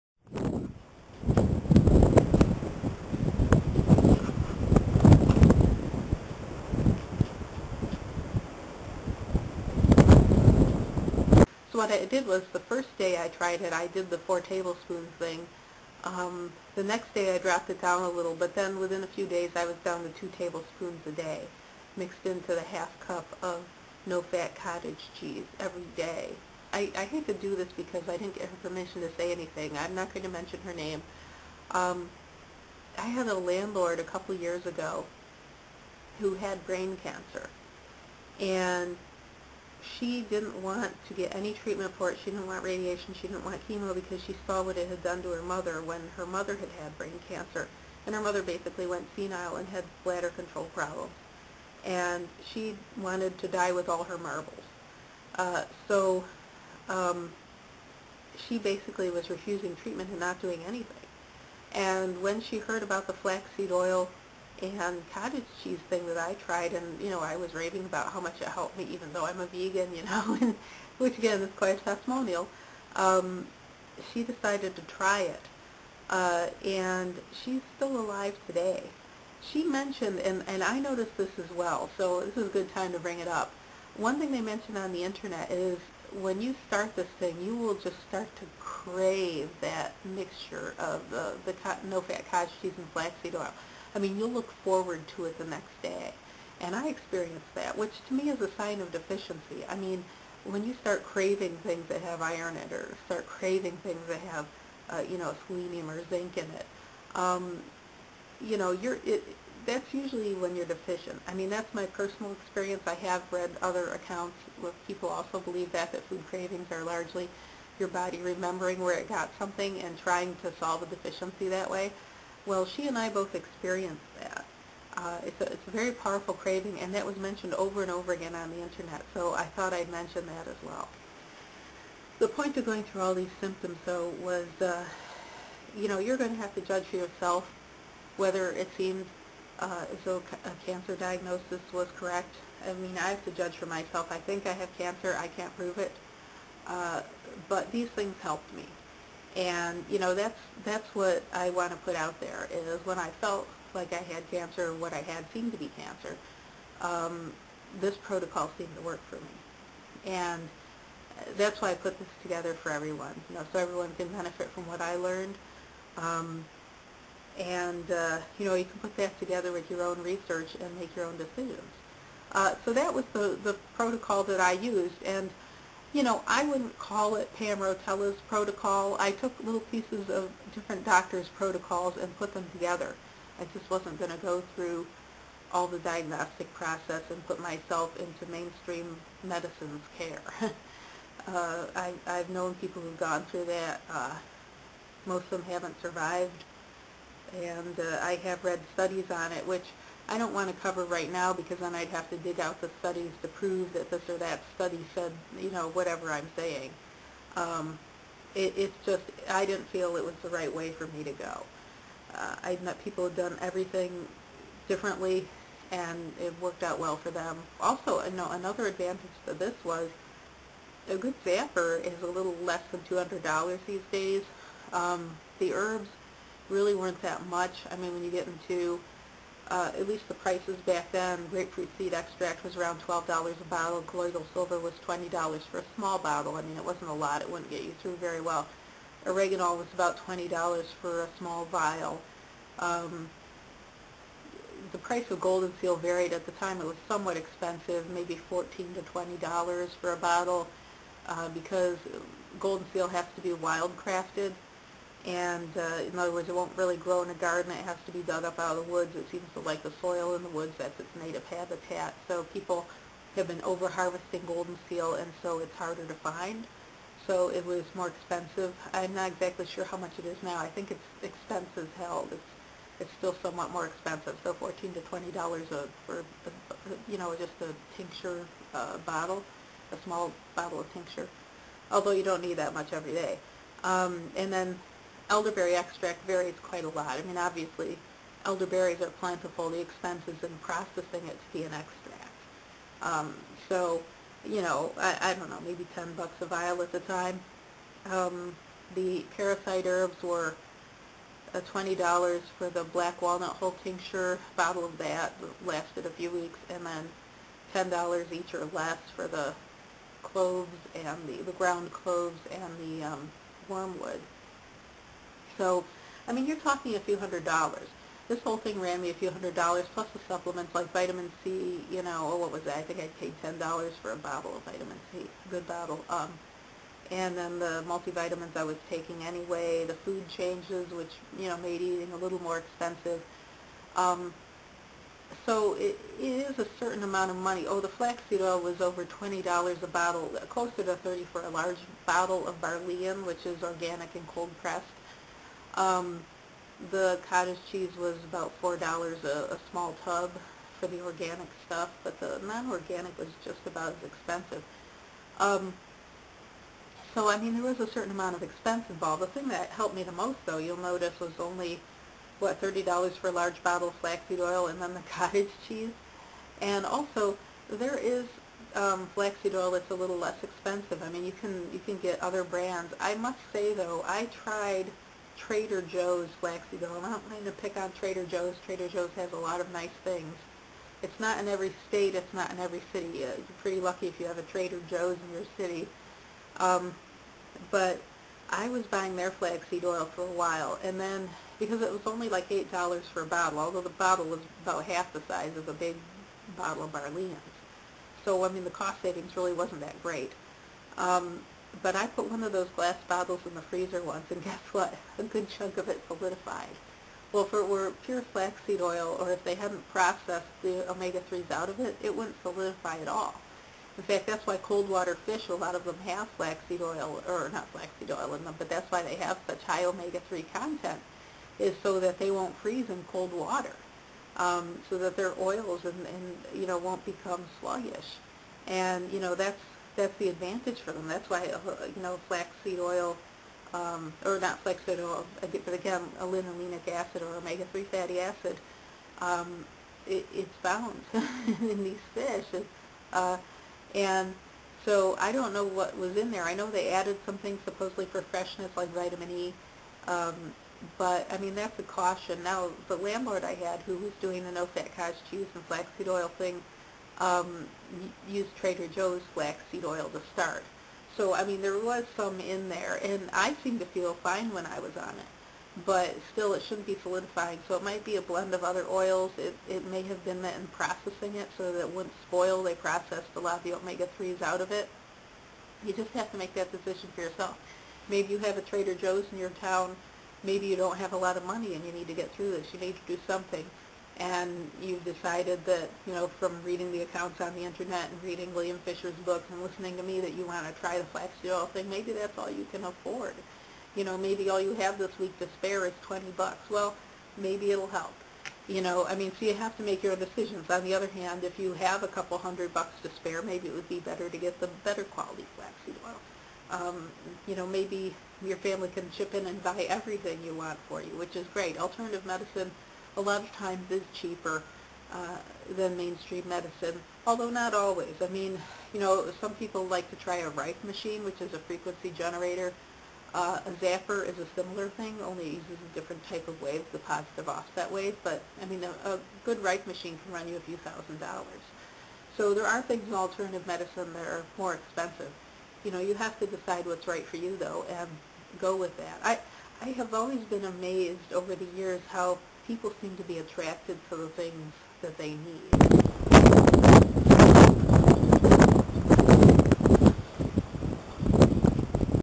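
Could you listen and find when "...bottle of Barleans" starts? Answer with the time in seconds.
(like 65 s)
396 s.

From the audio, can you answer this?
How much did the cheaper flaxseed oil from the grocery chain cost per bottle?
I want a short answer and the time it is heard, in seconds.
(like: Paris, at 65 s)
$8, at 392 s.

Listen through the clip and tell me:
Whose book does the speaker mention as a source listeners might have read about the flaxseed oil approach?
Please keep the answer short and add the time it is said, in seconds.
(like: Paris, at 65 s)
William Fischer, at 488 s.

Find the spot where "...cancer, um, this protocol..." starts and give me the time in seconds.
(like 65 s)
155 s.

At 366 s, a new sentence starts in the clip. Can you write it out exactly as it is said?
And also, there is um, flaxseed oil that's a little less expensive.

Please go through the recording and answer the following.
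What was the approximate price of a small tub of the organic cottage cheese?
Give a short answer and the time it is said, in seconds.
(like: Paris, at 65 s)
$4, at 348 s.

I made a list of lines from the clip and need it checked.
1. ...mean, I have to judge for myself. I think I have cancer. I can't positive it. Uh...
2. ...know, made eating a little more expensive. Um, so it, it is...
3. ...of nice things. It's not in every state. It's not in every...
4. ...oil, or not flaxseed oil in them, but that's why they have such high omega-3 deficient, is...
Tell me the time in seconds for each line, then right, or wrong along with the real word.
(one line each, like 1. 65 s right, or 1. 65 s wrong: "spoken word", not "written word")
1. 142 s wrong: "prove", not "positive"
2. 331 s right
3. 379 s right
4. 416 s wrong: "content", not "deficient".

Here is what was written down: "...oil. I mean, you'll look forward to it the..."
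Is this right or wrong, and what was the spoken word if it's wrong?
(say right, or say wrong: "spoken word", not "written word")
right.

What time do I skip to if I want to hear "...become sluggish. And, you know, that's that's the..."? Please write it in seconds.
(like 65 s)
426 s.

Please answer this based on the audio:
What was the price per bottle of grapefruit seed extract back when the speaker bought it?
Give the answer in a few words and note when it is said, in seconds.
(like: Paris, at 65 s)
$12, at 232 s.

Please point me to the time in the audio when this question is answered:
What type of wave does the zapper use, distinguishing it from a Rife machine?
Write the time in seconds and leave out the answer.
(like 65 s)
526 s.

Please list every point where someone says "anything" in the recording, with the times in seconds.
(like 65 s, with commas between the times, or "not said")
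29 s, 60 s.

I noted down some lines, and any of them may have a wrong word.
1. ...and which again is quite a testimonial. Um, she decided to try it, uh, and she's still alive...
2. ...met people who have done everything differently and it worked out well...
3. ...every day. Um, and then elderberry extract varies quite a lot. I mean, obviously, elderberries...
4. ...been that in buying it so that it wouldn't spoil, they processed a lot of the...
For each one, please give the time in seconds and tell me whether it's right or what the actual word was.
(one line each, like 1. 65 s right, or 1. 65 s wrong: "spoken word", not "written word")
1. 70 s right
2. 212 s right
3. 282 s right
4. 470 s wrong: "processing", not "buying".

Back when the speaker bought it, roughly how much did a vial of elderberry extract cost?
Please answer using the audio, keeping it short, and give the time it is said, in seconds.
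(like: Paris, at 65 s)
10 bucks, at 295 s.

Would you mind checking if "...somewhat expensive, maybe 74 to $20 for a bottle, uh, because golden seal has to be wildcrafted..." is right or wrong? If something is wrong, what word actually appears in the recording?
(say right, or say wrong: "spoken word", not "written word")
wrong: "14", not "74".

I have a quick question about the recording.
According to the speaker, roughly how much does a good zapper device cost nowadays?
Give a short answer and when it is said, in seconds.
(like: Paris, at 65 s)
a little less than $200, at 222 s.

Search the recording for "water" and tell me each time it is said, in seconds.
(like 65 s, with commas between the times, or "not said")
414 s, 423 s.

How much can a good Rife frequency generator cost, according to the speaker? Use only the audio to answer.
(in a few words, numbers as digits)
a few thousand dollars.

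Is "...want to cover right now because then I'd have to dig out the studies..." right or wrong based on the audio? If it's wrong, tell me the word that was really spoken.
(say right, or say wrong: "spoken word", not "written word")
right.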